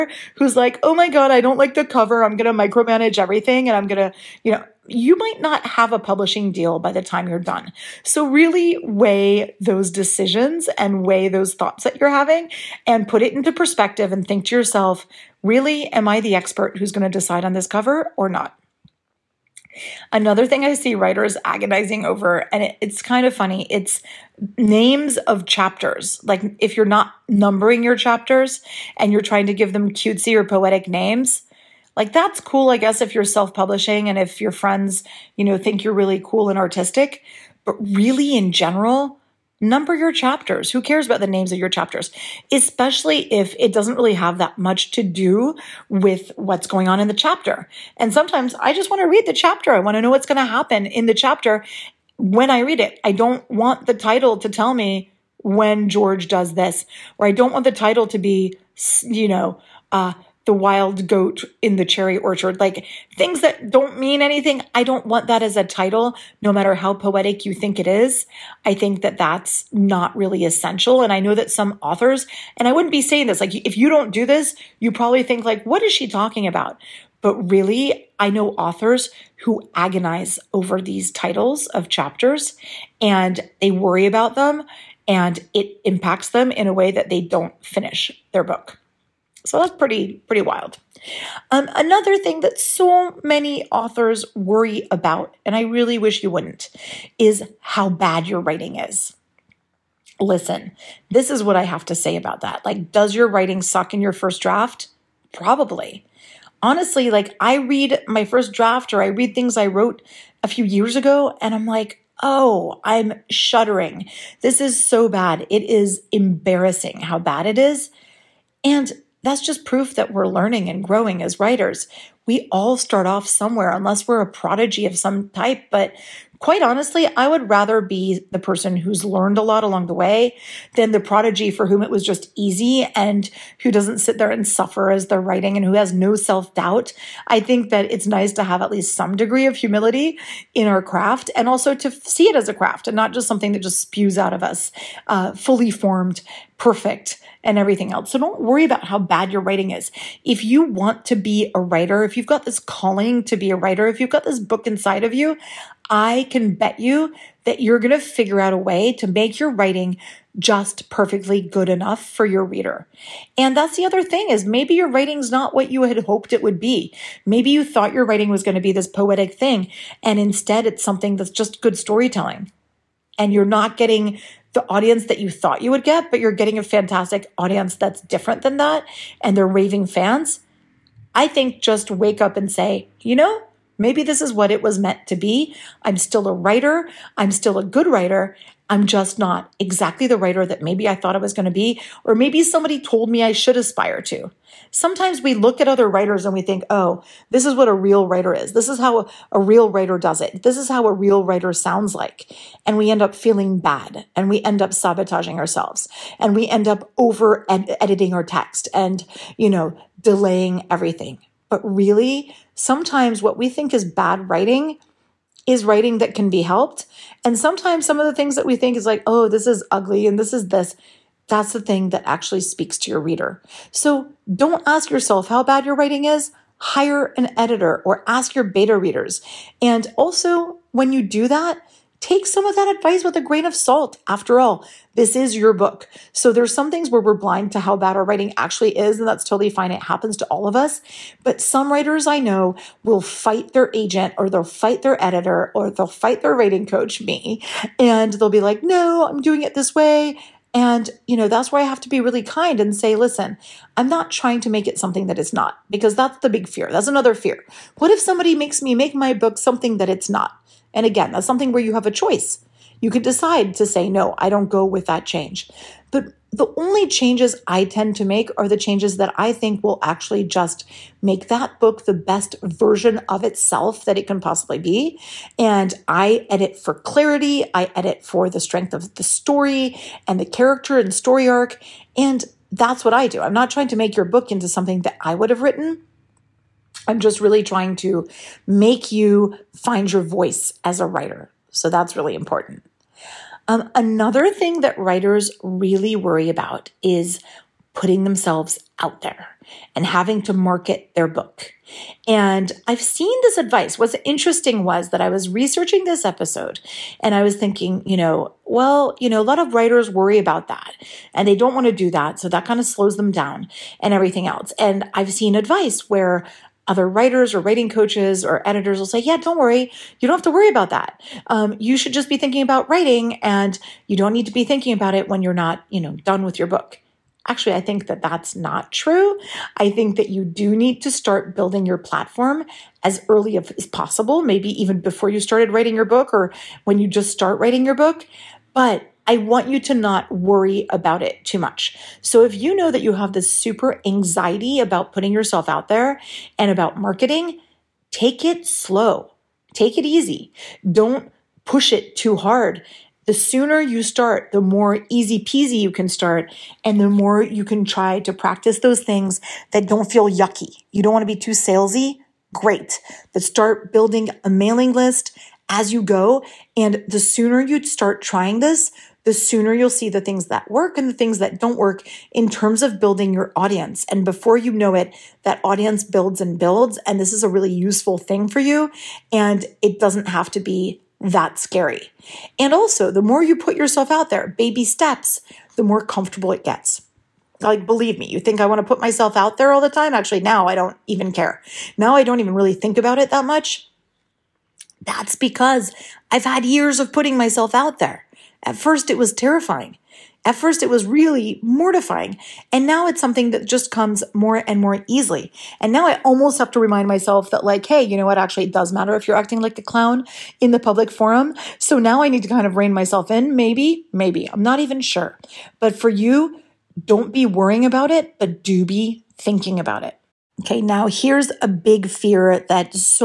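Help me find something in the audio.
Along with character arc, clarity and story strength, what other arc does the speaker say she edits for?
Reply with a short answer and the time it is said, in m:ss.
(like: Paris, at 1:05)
Story arc, at 4:40.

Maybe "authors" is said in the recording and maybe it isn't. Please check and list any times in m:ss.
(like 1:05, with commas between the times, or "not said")
1:11, 1:18, 1:33.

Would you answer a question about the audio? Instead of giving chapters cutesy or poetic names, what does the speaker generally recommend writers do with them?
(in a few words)
Number your chapters.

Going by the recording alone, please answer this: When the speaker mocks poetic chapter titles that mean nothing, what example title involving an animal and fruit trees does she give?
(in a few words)
The wild goat in the cherry orchard.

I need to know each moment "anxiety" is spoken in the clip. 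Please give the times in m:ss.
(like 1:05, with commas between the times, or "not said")
5:43.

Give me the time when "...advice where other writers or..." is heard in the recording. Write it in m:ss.
5:15.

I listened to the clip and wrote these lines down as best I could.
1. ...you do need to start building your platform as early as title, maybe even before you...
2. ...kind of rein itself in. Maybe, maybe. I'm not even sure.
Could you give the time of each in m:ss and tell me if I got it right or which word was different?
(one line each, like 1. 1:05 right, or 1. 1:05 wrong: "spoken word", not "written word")
1. 5:30 wrong: "possible", not "title"
2. 6:52 wrong: "myself", not "itself".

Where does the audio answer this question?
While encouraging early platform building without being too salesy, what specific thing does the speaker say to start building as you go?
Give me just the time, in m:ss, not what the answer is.
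6:04.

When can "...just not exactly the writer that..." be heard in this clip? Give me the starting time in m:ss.
3:08.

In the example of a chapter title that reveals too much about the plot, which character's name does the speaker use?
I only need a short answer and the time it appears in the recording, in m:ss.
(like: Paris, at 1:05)
George, at 0:55.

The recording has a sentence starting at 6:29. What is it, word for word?
Actually, now I don't even care.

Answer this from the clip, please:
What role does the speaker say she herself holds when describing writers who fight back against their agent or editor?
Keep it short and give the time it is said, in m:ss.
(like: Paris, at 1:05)
Writing coach, at 4:06.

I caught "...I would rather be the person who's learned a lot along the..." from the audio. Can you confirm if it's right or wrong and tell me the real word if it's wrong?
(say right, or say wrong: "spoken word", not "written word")
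right.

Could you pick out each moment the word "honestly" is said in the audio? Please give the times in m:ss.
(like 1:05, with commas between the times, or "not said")
1:46, 2:06.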